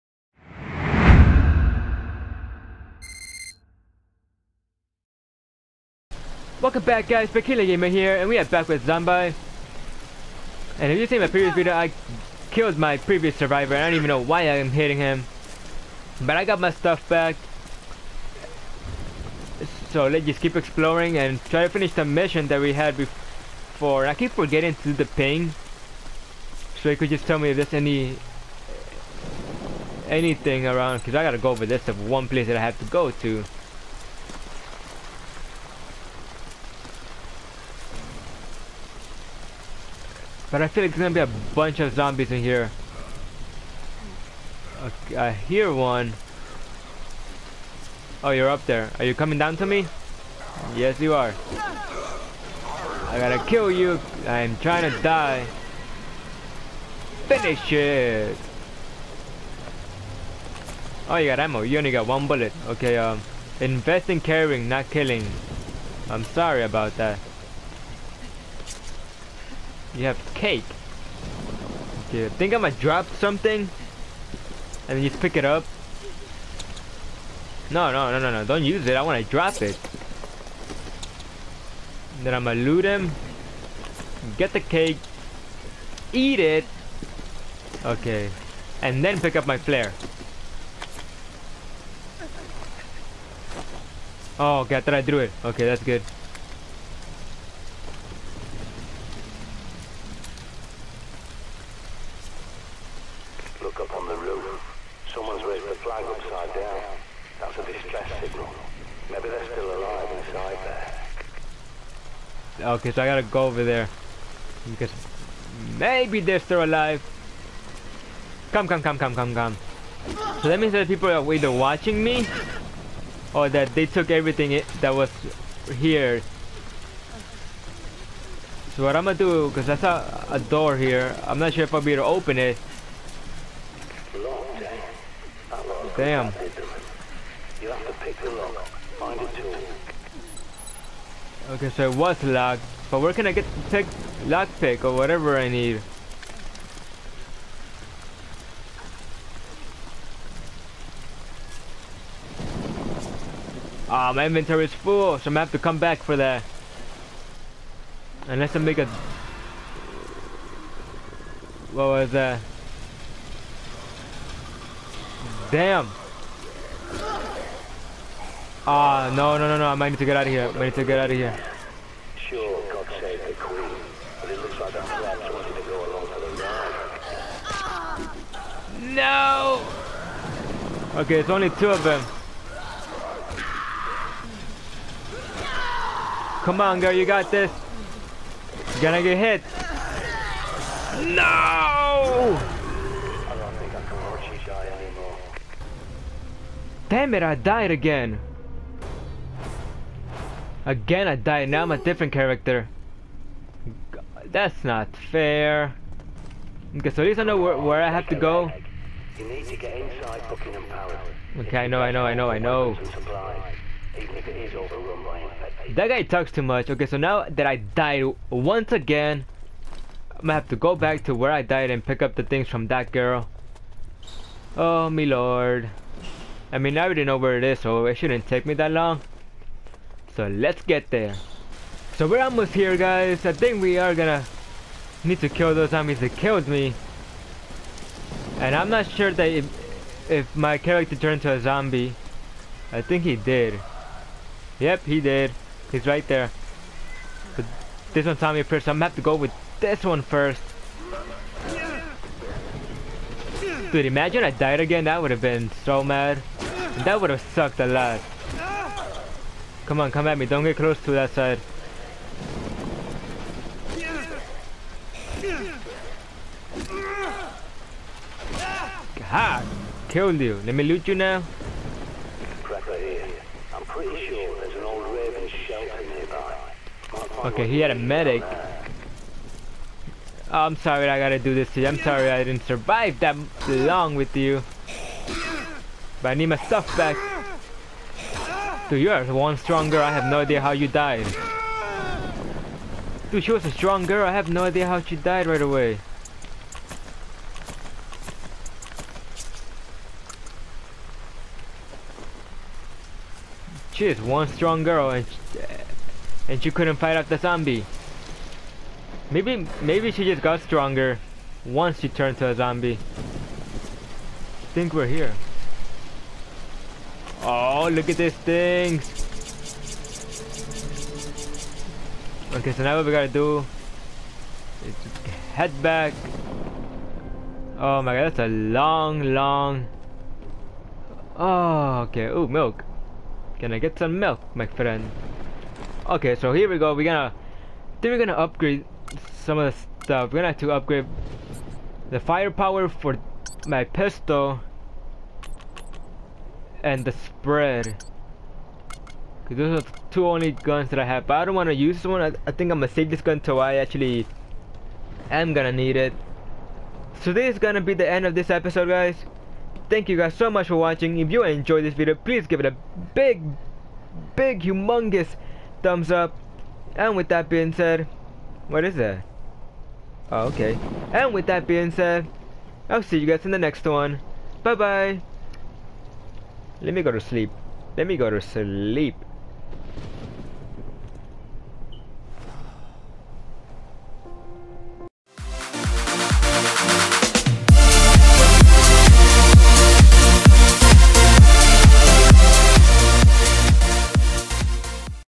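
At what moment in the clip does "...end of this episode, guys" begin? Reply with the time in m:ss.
5:57.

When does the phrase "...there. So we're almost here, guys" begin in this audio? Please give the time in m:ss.
3:50.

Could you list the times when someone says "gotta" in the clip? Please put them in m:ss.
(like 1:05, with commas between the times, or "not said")
0:31, 0:53, 1:53, 4:40, 5:22.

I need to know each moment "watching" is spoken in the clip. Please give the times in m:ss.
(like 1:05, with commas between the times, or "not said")
2:01, 6:00.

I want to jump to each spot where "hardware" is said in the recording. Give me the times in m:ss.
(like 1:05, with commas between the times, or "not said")
not said.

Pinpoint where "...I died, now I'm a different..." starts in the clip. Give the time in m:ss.
3:21.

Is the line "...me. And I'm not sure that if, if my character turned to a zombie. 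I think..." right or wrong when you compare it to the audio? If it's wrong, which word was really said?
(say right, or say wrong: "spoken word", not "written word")
right.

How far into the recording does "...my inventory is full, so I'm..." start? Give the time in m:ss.
2:34.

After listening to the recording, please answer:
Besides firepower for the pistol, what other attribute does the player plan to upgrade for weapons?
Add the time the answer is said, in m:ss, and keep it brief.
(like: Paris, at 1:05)
Spread, at 5:46.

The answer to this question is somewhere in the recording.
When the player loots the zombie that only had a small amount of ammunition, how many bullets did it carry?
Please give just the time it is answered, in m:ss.
1:02.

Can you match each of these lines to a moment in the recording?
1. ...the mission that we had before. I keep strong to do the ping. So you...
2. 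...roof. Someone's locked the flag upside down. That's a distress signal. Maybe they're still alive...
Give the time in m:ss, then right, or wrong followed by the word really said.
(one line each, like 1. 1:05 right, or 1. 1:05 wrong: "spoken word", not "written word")
1. 0:21 wrong: "forgetting", not "strong"
2. 1:44 wrong: "raised", not "locked".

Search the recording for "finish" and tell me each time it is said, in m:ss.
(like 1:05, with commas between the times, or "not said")
0:21, 0:57.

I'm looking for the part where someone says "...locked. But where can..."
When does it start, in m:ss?
2:22.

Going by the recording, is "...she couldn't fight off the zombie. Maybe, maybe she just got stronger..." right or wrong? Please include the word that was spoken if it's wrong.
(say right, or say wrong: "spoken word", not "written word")
right.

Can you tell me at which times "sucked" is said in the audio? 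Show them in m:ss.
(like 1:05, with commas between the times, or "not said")
4:17.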